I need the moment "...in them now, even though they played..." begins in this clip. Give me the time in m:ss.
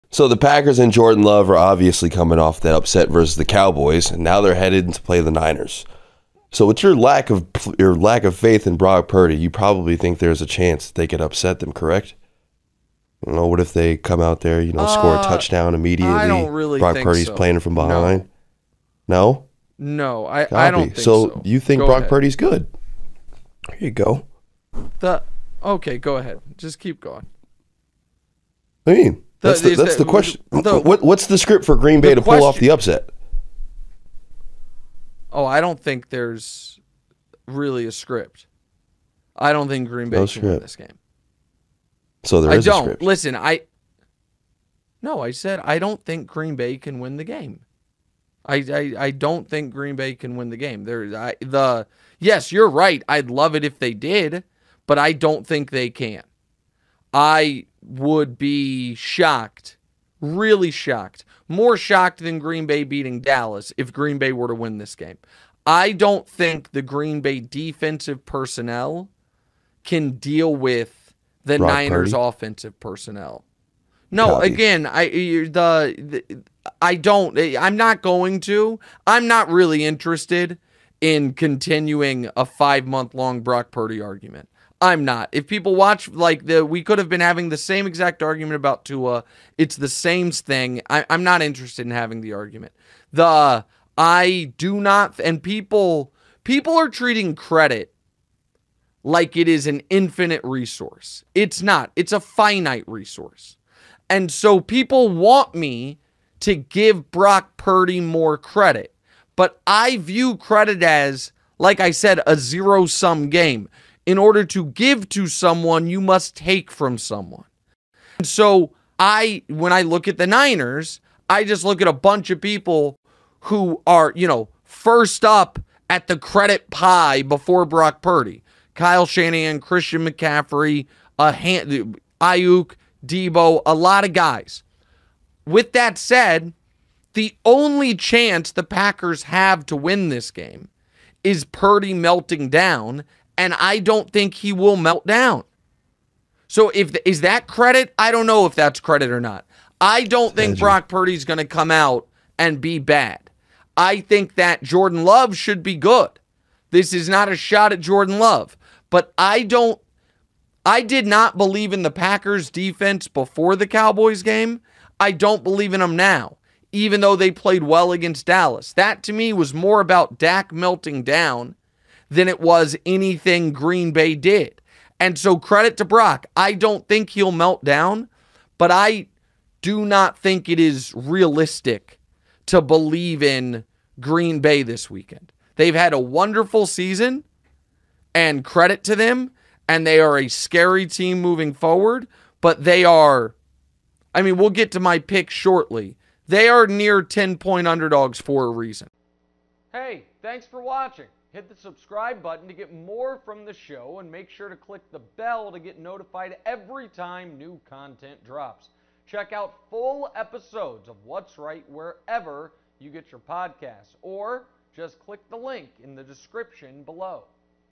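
2:45.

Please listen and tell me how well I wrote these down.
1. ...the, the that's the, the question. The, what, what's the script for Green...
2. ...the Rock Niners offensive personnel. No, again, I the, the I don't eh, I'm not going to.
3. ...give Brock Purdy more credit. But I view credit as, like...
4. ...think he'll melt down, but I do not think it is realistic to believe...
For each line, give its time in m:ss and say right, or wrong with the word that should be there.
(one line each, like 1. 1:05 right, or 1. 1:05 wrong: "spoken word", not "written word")
1. 0:29 right
2. 1:11 right
3. 1:46 right
4. 2:56 right.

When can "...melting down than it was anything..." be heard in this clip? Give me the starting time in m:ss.
2:50.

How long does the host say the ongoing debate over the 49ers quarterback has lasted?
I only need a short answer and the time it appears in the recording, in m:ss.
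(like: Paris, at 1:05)
5 months, at 1:22.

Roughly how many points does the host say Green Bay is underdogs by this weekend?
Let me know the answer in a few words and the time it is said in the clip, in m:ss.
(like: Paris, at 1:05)
10, at 3:17.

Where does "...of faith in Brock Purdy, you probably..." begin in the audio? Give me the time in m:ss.
0:08.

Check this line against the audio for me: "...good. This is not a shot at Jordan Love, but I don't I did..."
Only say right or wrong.
right.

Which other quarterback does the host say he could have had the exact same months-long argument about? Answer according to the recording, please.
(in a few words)
Tua.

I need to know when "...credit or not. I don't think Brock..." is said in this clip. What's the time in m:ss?
2:28.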